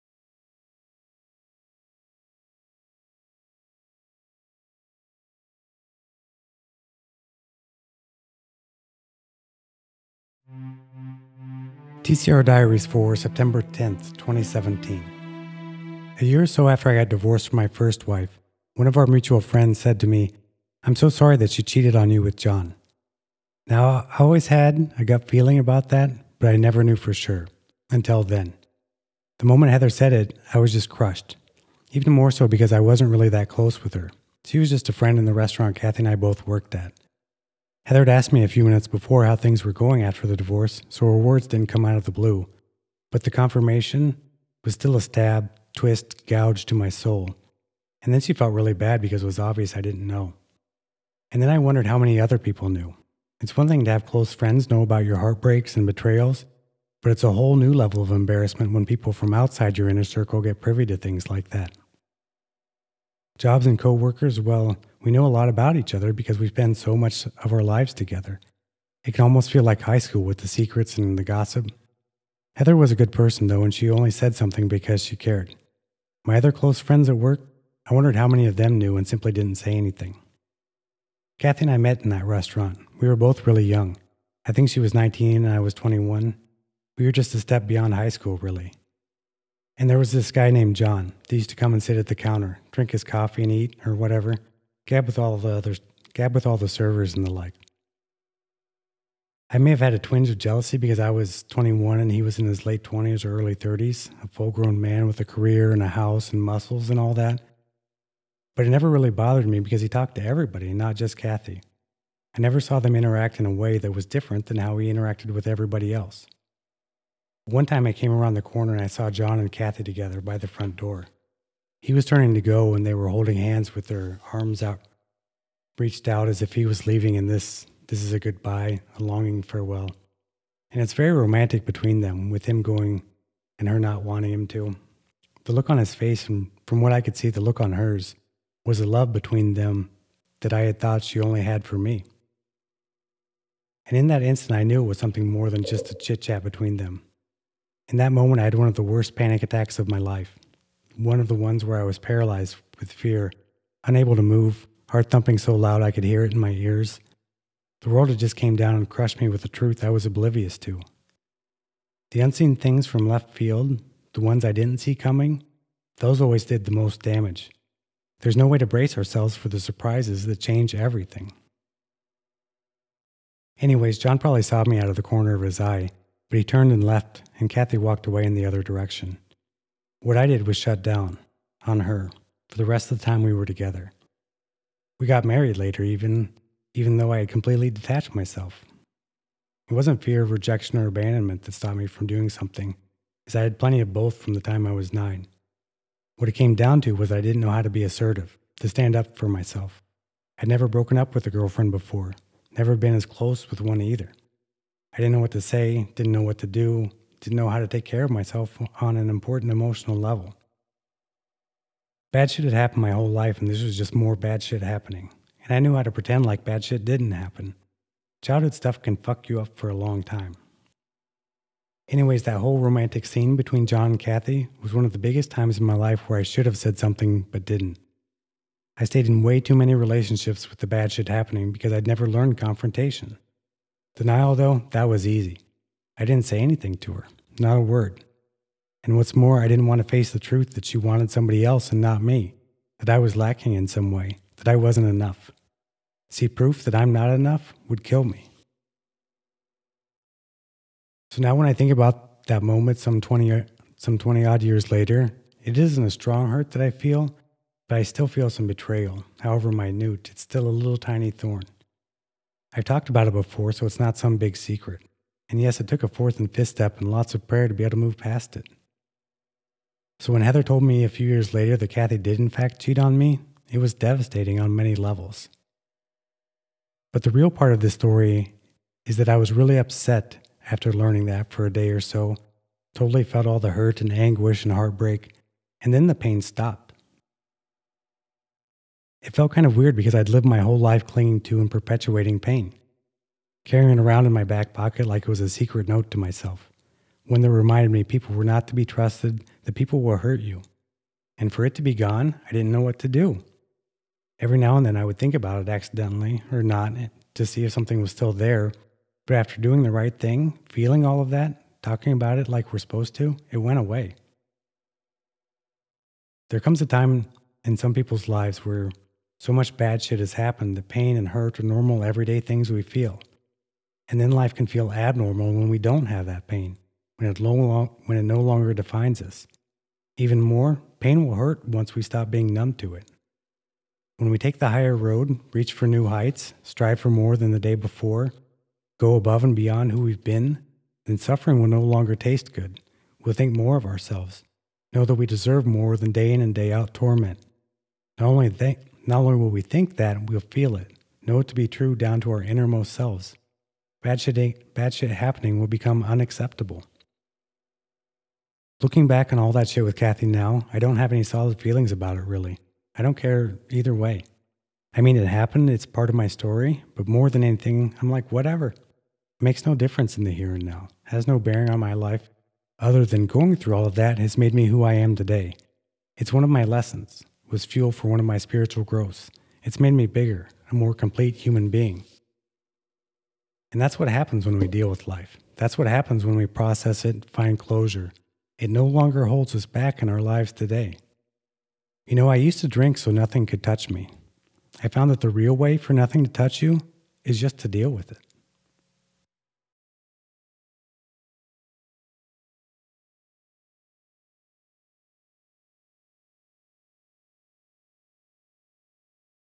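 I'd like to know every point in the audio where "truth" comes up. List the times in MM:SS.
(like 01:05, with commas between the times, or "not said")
02:39, 04:00.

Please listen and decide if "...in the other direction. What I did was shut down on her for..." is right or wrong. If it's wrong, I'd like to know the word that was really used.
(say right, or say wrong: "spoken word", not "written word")
right.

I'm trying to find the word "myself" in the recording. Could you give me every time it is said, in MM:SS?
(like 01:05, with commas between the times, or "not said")
03:08, 03:19, 03:28, 04:55.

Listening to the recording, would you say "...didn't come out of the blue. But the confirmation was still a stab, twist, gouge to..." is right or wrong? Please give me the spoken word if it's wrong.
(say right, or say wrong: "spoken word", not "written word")
right.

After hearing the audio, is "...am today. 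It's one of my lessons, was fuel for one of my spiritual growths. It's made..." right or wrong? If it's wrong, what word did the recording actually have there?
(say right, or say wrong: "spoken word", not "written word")
right.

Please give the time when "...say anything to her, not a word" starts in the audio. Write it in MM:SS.
03:56.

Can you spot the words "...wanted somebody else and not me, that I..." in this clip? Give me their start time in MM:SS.
04:00.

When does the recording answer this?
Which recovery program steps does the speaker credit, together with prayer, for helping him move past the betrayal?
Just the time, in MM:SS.
04:25.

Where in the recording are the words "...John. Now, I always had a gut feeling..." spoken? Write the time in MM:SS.
00:22.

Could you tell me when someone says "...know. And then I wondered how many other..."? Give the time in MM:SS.
00:50.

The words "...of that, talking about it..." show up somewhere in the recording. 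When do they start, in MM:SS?
05:11.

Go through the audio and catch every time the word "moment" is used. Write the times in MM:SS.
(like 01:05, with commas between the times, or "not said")
00:29, 02:28, 04:12.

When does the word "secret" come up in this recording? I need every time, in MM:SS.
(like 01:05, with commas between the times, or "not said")
01:10, 04:24, 04:55.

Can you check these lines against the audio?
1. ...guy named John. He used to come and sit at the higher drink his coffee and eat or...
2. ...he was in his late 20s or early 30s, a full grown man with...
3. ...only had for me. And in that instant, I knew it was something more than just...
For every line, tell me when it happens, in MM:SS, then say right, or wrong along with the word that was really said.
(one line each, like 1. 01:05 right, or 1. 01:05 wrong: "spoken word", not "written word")
1. 01:30 wrong: "counter", not "higher"
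2. 01:42 right
3. 02:21 right.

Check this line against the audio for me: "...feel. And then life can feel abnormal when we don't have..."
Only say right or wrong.
right.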